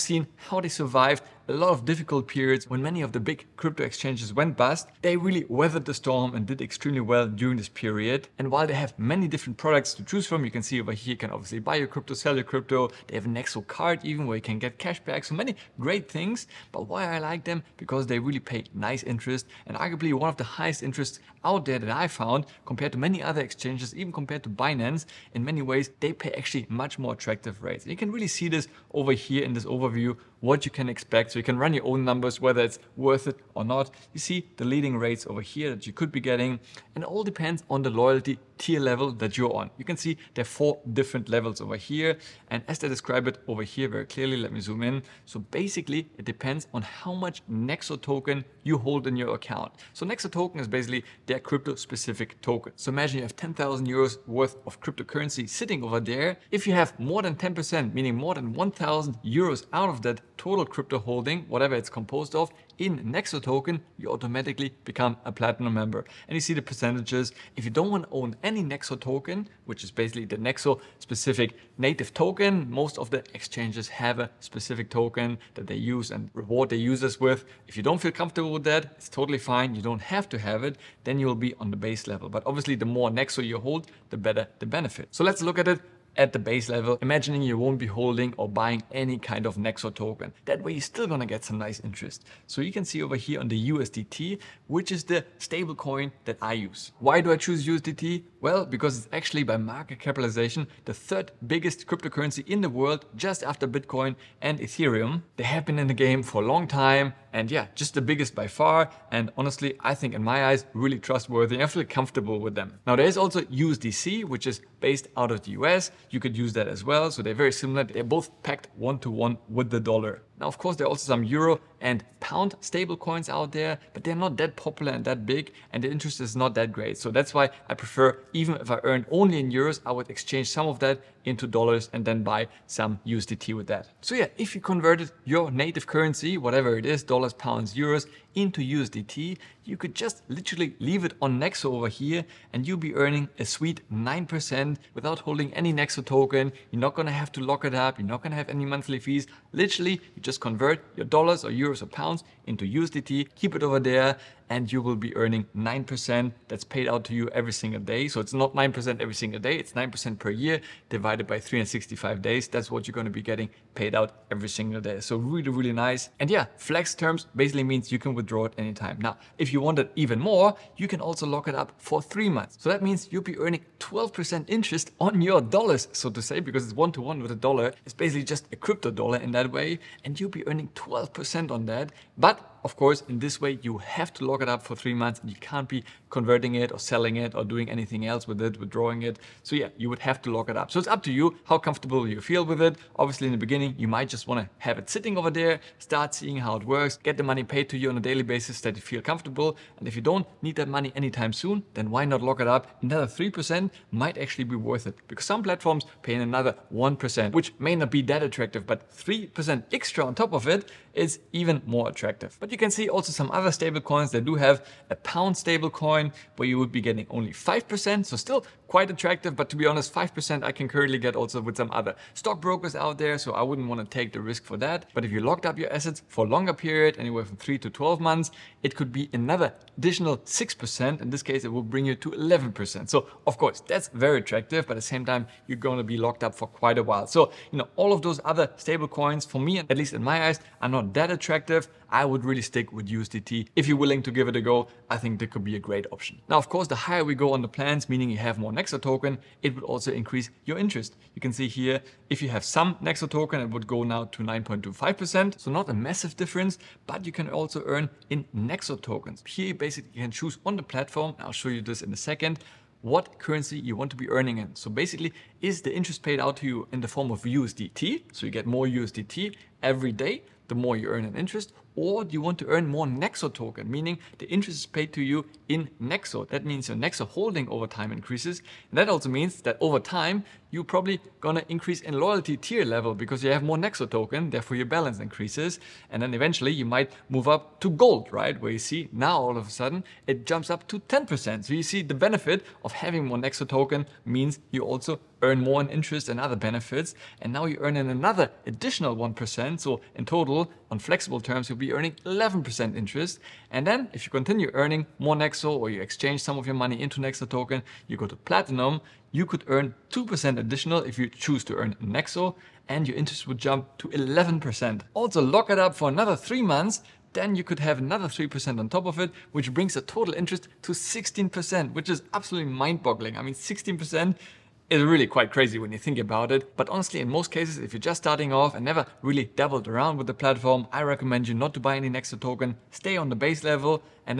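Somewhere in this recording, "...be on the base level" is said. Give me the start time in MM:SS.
01:21.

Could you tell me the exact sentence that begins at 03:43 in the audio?
So I wouldn't want to take the risk for that.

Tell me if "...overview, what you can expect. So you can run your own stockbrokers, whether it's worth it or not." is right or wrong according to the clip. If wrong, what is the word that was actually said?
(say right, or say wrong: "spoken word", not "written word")
wrong: "numbers", not "stockbrokers".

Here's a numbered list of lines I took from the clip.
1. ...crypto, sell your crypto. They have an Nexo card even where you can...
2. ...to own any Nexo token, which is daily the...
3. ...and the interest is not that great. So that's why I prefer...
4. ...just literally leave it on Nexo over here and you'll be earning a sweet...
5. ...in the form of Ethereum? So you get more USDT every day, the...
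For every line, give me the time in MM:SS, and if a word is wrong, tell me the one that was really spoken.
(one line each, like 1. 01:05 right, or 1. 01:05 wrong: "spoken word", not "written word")
1. 00:11 right
2. 01:08 wrong: "basically", not "daily"
3. 02:05 right
4. 02:19 right
5. 04:26 wrong: "USDT", not "Ethereum".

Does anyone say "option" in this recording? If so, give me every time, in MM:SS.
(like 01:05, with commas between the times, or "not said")
04:05.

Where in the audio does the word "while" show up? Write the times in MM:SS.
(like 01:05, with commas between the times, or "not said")
00:08, 03:56.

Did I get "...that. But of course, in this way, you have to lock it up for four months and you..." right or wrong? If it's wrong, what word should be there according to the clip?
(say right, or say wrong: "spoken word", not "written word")
wrong: "three", not "four".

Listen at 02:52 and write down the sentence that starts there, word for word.
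So that means you'll be earning 12% interest on your dollars, so to say, because it's one-to-one -one with a dollar.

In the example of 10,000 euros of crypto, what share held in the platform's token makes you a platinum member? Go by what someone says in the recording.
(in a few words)
More than 10%.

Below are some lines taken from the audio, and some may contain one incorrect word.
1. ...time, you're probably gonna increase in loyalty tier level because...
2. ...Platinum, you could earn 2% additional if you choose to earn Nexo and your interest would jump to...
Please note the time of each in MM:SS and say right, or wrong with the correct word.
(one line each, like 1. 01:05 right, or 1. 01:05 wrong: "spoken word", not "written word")
1. 04:39 right
2. 05:08 right.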